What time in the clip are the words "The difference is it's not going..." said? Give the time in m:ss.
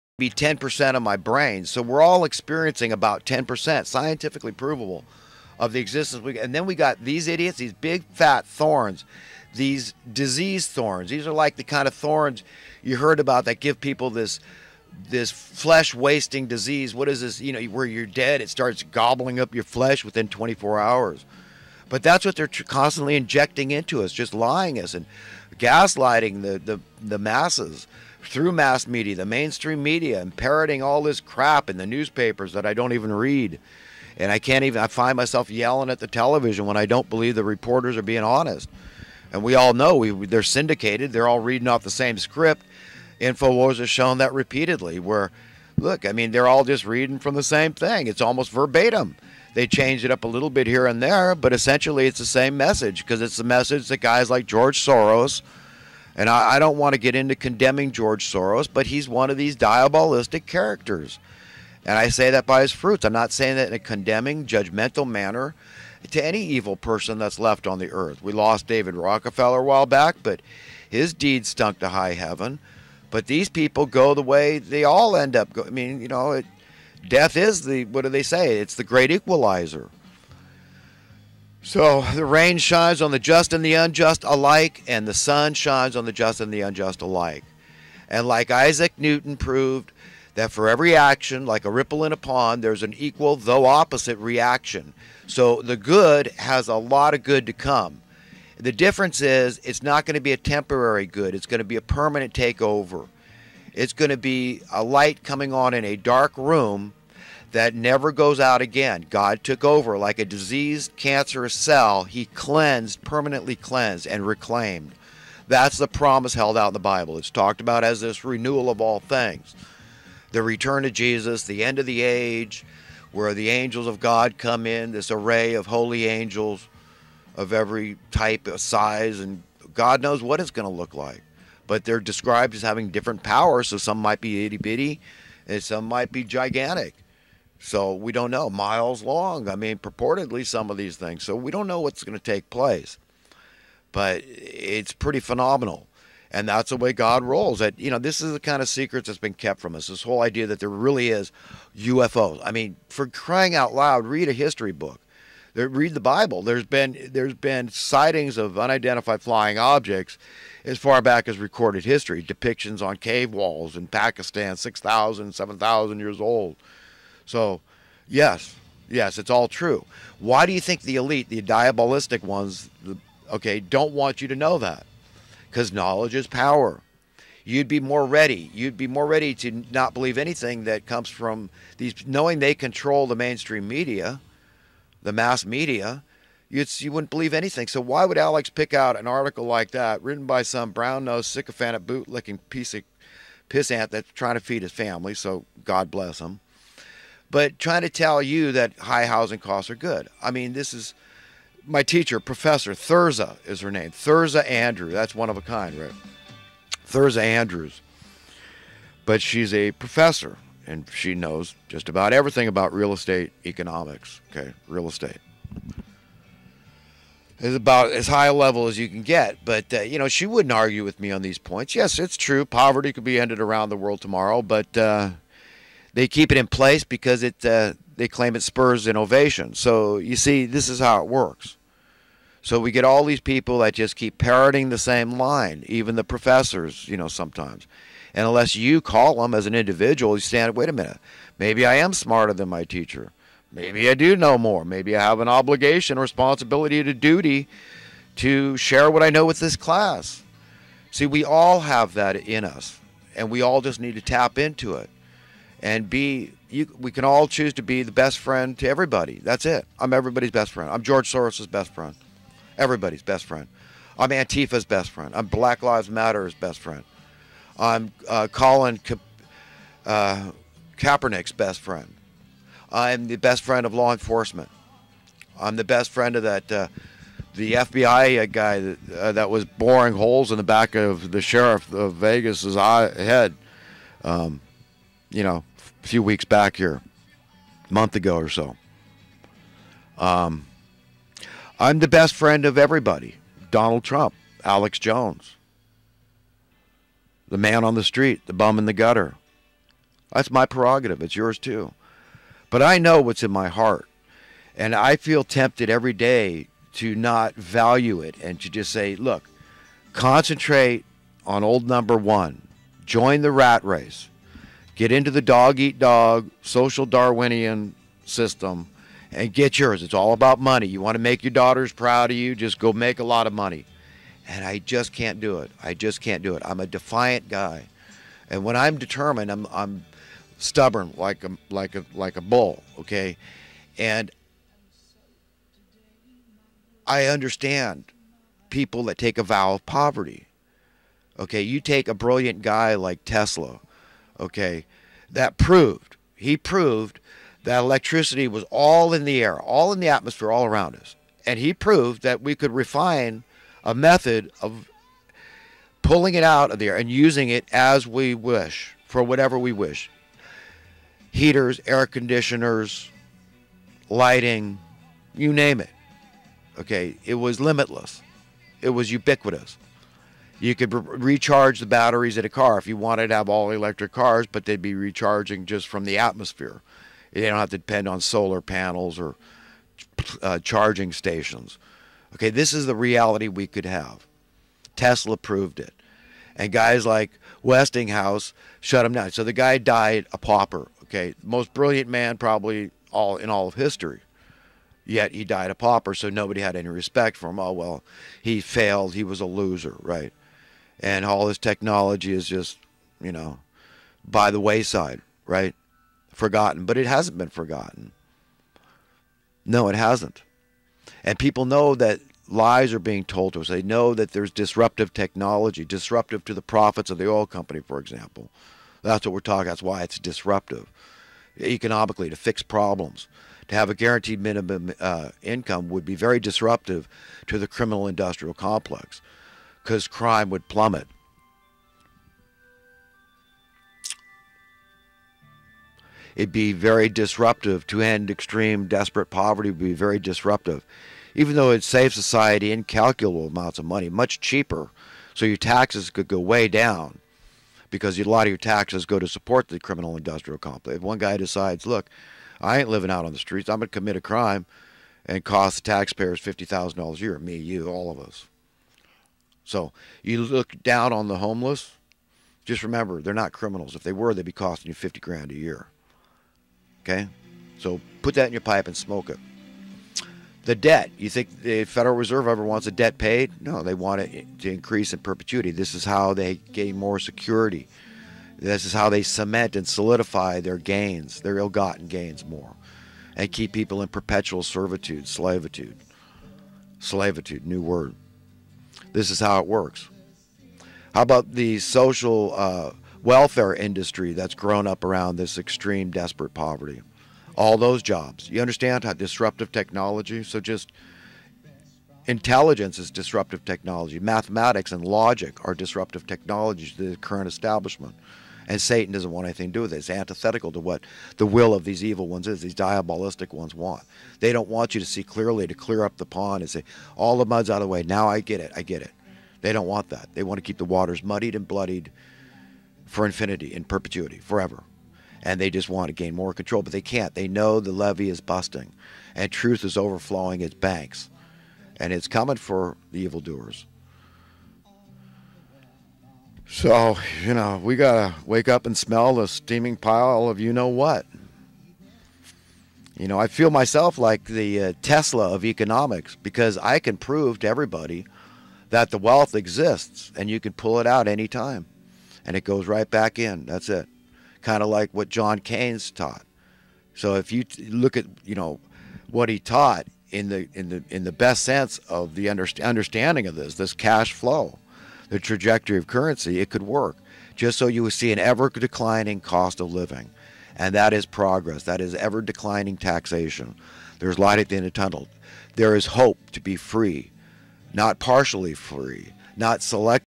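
1:38.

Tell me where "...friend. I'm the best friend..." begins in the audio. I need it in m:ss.
4:31.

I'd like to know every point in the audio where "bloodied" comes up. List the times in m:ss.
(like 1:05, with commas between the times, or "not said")
8:41.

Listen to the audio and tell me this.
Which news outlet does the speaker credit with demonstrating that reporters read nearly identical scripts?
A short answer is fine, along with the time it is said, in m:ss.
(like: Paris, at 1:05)
InfoWars, at 0:43.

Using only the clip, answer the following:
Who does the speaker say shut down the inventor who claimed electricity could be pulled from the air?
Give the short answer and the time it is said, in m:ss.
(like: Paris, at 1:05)
Westinghouse, at 6:27.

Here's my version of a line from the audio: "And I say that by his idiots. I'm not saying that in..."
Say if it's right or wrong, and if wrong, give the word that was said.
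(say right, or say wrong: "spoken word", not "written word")
wrong: "fruits", not "idiots".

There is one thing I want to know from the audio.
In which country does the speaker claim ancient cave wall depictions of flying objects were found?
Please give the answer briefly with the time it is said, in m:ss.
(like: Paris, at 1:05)
Pakistan, at 2:43.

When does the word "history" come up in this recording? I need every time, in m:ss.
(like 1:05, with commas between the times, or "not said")
2:34, 2:41, 6:33.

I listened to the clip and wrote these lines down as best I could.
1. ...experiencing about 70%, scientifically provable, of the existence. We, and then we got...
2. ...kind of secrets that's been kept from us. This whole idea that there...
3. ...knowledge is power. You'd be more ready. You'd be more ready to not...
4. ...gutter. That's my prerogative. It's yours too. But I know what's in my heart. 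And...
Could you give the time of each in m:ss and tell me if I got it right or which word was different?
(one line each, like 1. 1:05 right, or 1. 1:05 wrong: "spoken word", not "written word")
1. 0:02 wrong: "10", not "70"
2. 2:28 right
3. 2:55 right
4. 4:58 right.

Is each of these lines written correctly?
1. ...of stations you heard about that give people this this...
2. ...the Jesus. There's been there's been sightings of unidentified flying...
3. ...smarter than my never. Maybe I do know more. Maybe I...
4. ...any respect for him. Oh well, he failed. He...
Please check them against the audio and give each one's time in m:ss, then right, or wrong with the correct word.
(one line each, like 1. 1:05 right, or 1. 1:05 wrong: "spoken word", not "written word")
1. 0:11 wrong: "thorns", not "stations"
2. 2:35 wrong: "Bible", not "Jesus"
3. 4:01 wrong: "teacher", not "never"
4. 6:36 right.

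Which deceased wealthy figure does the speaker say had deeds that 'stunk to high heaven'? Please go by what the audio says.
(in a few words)
David Rockefeller.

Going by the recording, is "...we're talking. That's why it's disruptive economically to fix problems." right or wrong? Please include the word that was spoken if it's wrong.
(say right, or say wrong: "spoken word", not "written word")
right.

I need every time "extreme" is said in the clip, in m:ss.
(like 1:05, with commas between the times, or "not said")
7:18, 8:15.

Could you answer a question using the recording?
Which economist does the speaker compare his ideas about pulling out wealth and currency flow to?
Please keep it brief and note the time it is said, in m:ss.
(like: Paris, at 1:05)
John Keynes, at 9:15.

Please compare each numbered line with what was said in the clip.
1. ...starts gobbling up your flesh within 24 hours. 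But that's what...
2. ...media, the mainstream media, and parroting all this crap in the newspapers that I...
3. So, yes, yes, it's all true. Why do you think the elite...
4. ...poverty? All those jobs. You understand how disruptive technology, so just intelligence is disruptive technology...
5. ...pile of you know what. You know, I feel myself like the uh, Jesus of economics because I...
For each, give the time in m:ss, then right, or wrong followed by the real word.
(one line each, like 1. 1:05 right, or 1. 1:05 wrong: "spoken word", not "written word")
1. 0:18 right
2. 0:28 right
3. 2:47 right
4. 8:16 right
5. 8:59 wrong: "Tesla", not "Jesus".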